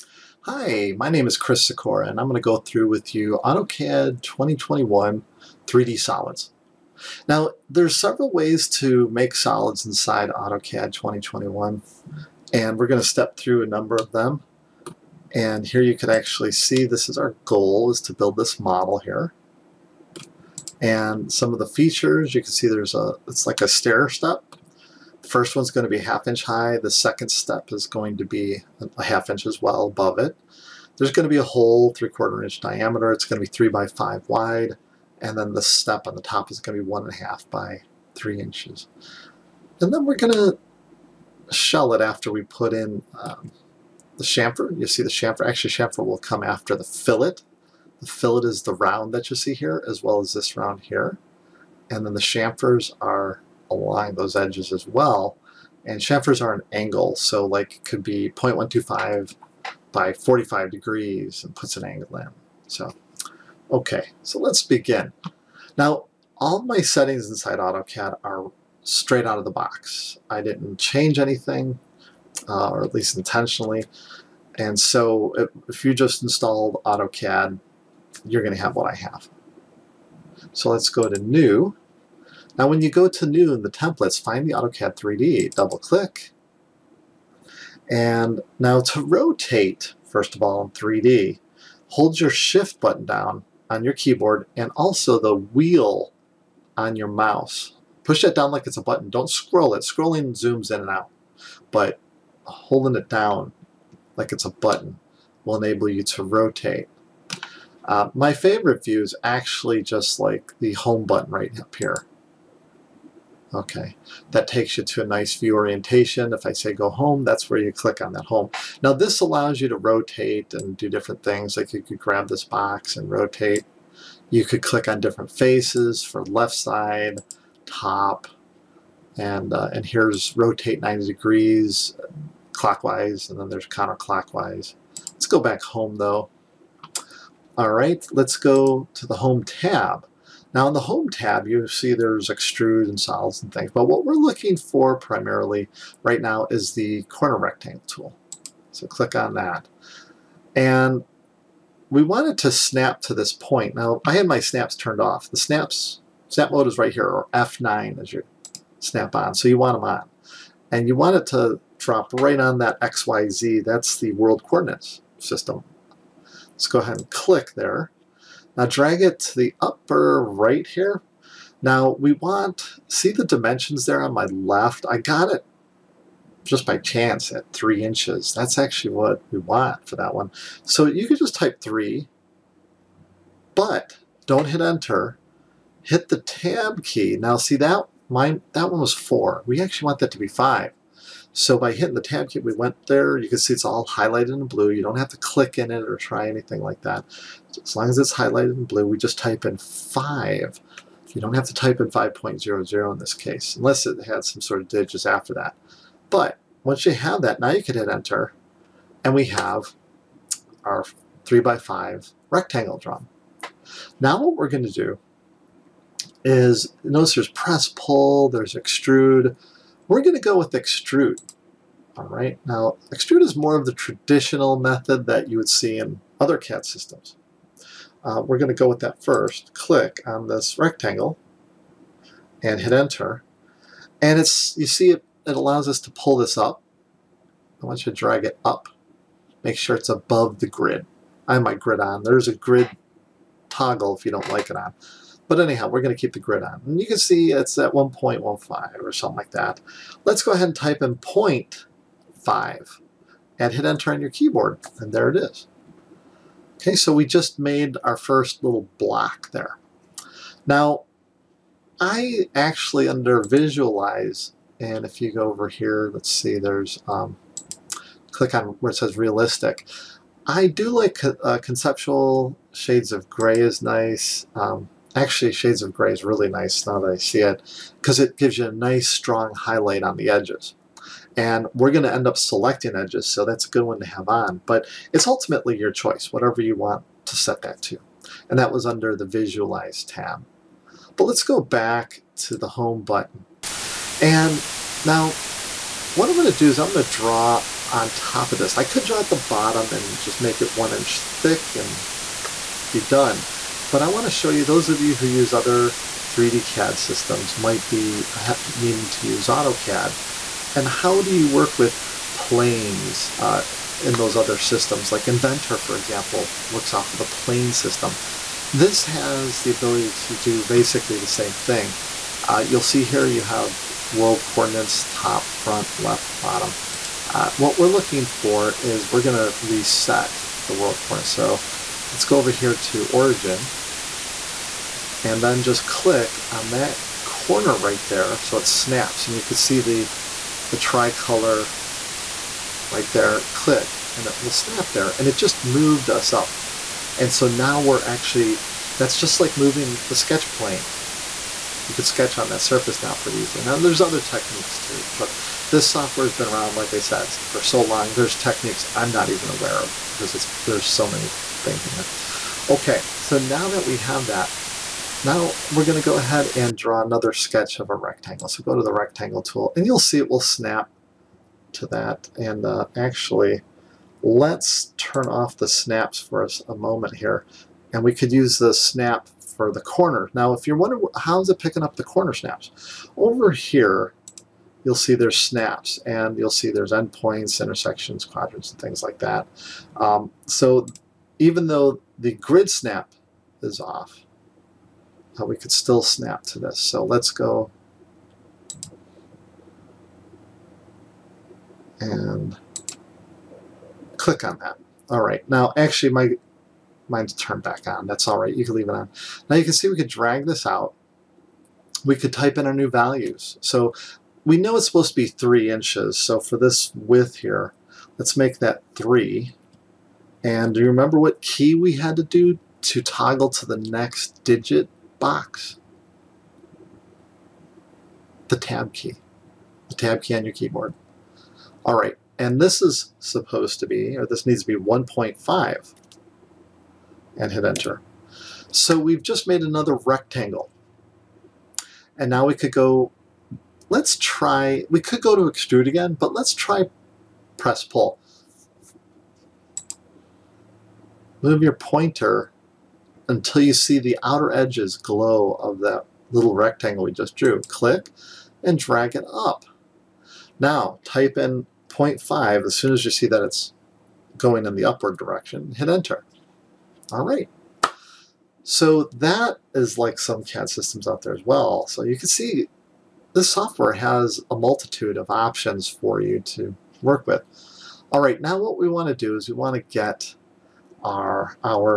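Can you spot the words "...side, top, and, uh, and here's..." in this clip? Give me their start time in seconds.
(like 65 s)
126 s.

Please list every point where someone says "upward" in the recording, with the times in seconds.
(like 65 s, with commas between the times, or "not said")
464 s.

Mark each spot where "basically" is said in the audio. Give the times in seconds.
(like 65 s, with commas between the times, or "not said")
320 s.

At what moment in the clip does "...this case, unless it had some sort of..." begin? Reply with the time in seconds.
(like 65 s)
202 s.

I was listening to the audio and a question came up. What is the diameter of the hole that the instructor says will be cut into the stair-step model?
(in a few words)
3/4 inch.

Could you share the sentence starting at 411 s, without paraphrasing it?
We could type in our new values.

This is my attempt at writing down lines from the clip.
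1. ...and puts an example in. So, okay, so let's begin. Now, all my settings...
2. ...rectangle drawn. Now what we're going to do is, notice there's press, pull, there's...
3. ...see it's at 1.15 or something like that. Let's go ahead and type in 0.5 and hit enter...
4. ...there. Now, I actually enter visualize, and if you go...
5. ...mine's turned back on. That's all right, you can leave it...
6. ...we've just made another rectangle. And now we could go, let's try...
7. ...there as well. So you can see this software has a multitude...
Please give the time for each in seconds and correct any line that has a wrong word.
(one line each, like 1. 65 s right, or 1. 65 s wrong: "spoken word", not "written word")
1. 61 s wrong: "angle", not "example"
2. 212 s right
3. 246 s right
4. 259 s wrong: "under", not "enter"
5. 406 s right
6. 438 s right
7. 471 s right.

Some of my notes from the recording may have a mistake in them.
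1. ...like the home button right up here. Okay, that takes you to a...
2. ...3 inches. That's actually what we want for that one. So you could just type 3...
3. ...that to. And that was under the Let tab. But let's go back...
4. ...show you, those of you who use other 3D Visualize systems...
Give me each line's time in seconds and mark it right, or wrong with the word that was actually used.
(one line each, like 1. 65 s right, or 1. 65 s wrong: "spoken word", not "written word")
1. 110 s right
2. 177 s right
3. 287 s wrong: "Visualize", not "Let"
4. 304 s wrong: "CAD", not "Visualize".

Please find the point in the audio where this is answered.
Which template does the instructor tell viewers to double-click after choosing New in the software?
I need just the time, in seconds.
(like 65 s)
84 s.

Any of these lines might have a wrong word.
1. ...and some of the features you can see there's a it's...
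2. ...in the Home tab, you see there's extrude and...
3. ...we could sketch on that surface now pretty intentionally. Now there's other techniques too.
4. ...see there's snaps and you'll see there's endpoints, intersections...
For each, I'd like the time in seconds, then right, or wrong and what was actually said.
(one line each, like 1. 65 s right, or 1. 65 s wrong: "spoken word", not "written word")
1. 20 s right
2. 140 s right
3. 351 s wrong: "easily", not "intentionally"
4. 384 s right.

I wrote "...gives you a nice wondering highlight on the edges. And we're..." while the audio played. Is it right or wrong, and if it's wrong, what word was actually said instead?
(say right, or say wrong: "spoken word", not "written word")
wrong: "strong", not "wondering".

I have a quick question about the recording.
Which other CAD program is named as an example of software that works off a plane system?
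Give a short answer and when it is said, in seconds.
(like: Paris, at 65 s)
Inventor, at 315 s.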